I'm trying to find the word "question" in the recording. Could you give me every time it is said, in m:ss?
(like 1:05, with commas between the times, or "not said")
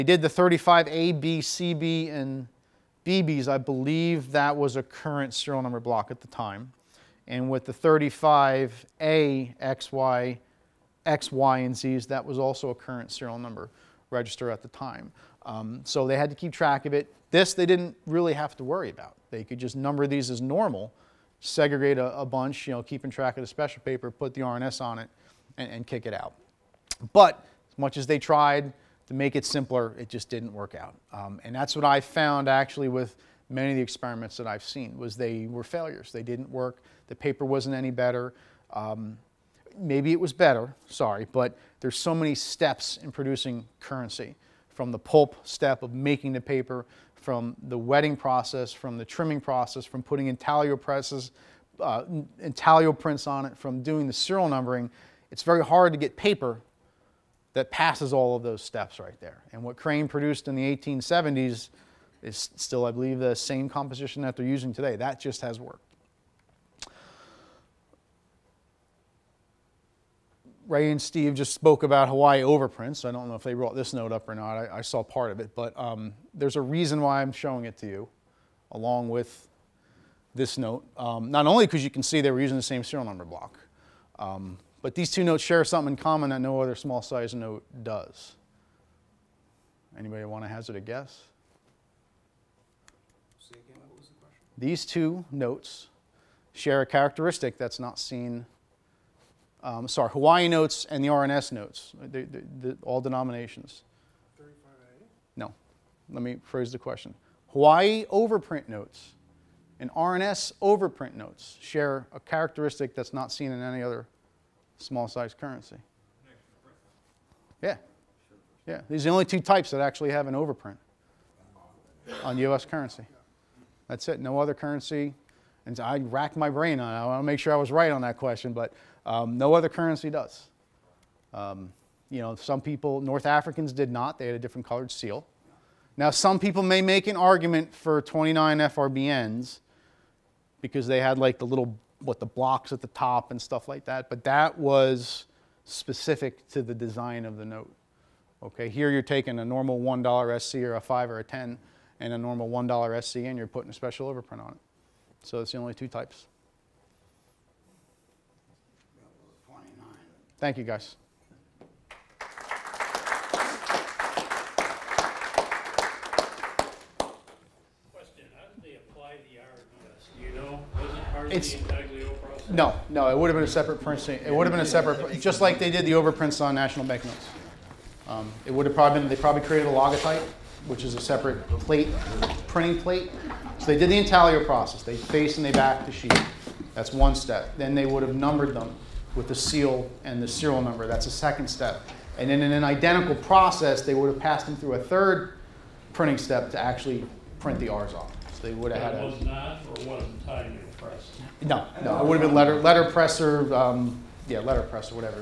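1:46, 2:08, 2:40.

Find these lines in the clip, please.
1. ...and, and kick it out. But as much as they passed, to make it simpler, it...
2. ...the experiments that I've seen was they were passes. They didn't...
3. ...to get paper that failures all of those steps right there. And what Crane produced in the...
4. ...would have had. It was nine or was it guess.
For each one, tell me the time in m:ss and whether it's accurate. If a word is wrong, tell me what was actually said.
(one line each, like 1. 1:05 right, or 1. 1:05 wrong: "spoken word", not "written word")
1. 0:25 wrong: "tried", not "passed"
2. 0:33 wrong: "failures", not "passes"
3. 0:55 wrong: "passes", not "failures"
4. 3:18 wrong: "press", not "guess".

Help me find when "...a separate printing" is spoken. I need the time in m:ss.
2:53.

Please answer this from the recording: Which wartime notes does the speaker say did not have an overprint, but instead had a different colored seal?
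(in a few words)
North Africans.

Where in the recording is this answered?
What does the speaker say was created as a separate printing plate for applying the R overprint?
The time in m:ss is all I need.
2:59.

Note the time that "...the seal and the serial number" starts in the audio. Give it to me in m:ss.
3:09.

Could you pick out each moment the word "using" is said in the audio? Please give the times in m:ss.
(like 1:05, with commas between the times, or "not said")
1:04, 1:22.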